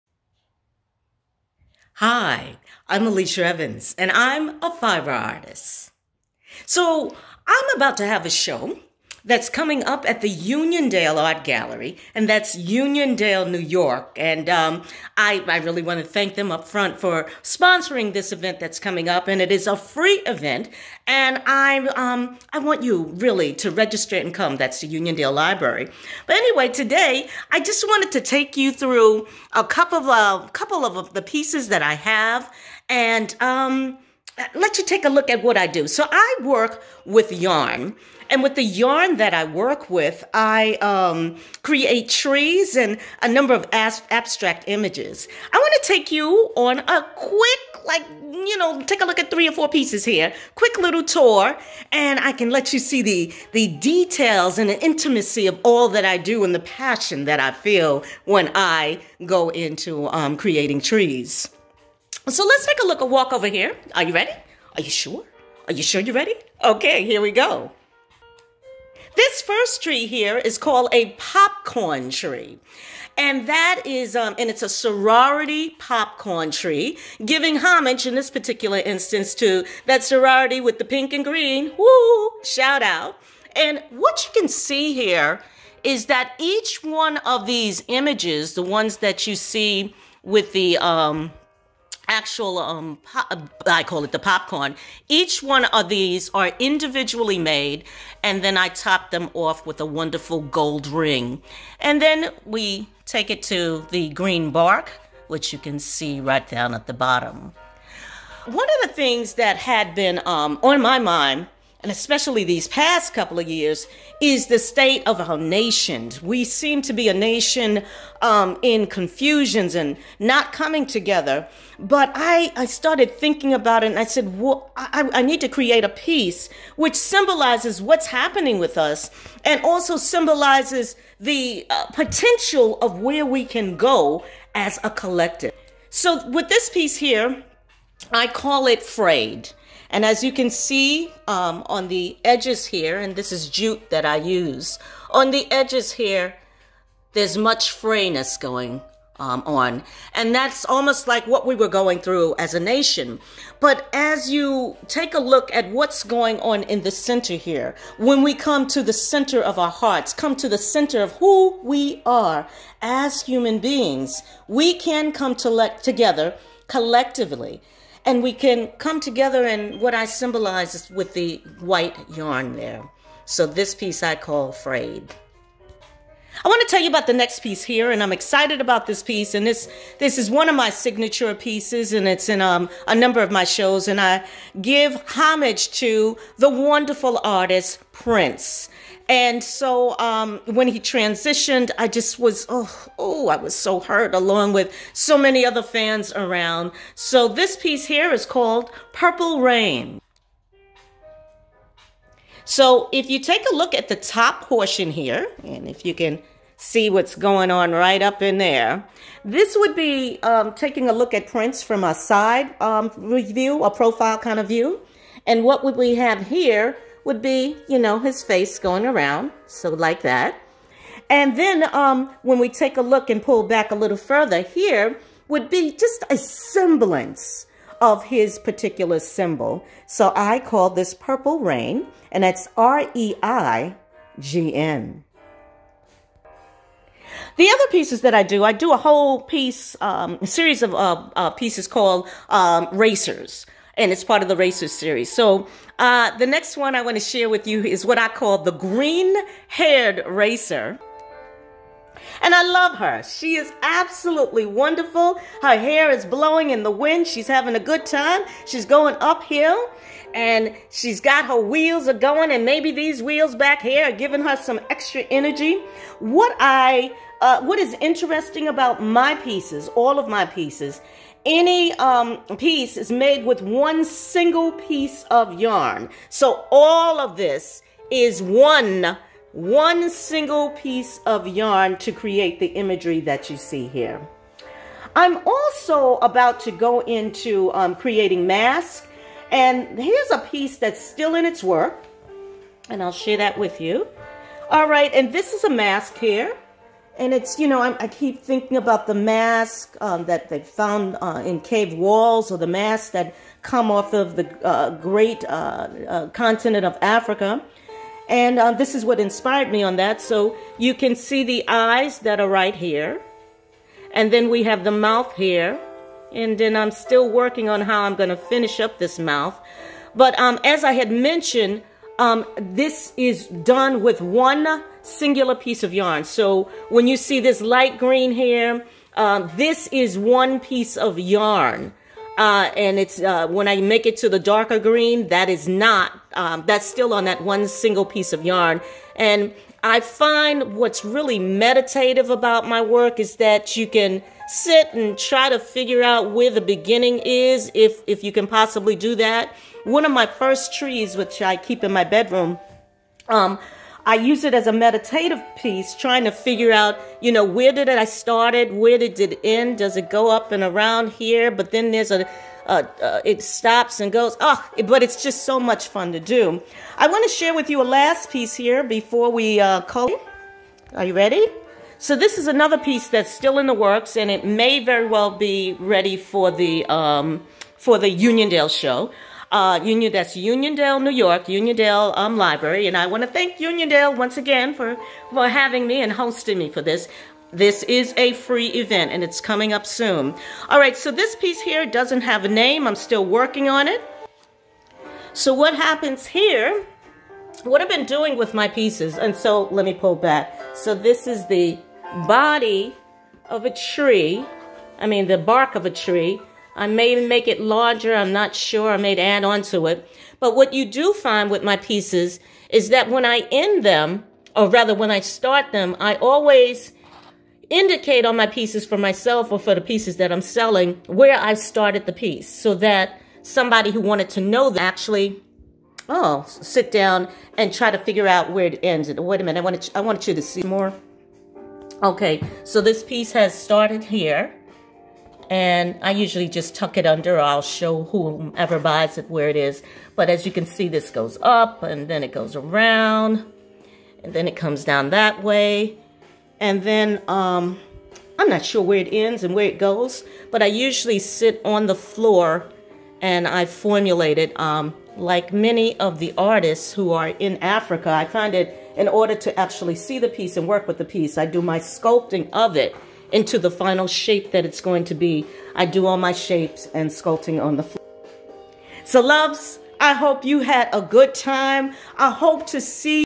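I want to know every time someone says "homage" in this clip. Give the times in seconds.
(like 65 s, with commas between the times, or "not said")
77 s, 185 s.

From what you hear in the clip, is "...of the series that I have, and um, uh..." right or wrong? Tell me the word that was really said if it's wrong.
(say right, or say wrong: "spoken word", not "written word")
wrong: "pieces", not "series".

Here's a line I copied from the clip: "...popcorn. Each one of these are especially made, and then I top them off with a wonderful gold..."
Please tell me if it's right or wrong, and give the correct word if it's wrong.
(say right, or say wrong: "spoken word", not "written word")
wrong: "individually", not "especially".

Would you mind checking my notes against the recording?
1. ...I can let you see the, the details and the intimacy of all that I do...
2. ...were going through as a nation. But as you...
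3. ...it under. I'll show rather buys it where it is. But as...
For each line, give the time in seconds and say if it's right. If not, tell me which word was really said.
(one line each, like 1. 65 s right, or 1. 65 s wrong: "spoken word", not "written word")
1. 52 s right
2. 151 s right
3. 436 s wrong: "whomever", not "rather".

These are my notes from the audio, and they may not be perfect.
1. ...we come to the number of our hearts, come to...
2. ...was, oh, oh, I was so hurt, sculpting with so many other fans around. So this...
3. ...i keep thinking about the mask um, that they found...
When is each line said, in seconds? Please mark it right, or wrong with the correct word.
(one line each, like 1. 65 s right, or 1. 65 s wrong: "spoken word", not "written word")
1. 158 s wrong: "center", not "number"
2. 192 s wrong: "along", not "sculpting"
3. 297 s right.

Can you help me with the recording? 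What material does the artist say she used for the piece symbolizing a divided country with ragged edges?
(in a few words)
Jute.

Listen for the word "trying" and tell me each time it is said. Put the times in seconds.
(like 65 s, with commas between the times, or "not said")
355 s.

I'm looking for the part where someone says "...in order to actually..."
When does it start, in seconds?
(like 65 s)
458 s.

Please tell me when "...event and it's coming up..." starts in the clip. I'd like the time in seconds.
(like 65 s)
388 s.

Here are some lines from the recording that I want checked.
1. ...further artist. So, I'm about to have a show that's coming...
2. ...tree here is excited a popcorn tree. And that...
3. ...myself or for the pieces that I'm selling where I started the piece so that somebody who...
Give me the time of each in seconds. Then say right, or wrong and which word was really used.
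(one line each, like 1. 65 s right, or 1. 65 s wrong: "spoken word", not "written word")
1. 4 s wrong: "fiber", not "further"
2. 69 s wrong: "called", not "excited"
3. 418 s right.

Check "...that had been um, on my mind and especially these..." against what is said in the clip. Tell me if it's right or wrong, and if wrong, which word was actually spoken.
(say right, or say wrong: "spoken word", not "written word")
right.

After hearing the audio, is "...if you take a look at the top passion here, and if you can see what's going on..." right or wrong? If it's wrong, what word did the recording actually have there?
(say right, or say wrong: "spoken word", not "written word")
wrong: "portion", not "passion".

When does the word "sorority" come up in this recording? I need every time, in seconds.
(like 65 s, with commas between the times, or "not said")
74 s, 80 s.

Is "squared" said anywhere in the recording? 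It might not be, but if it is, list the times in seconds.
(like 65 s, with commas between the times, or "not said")
not said.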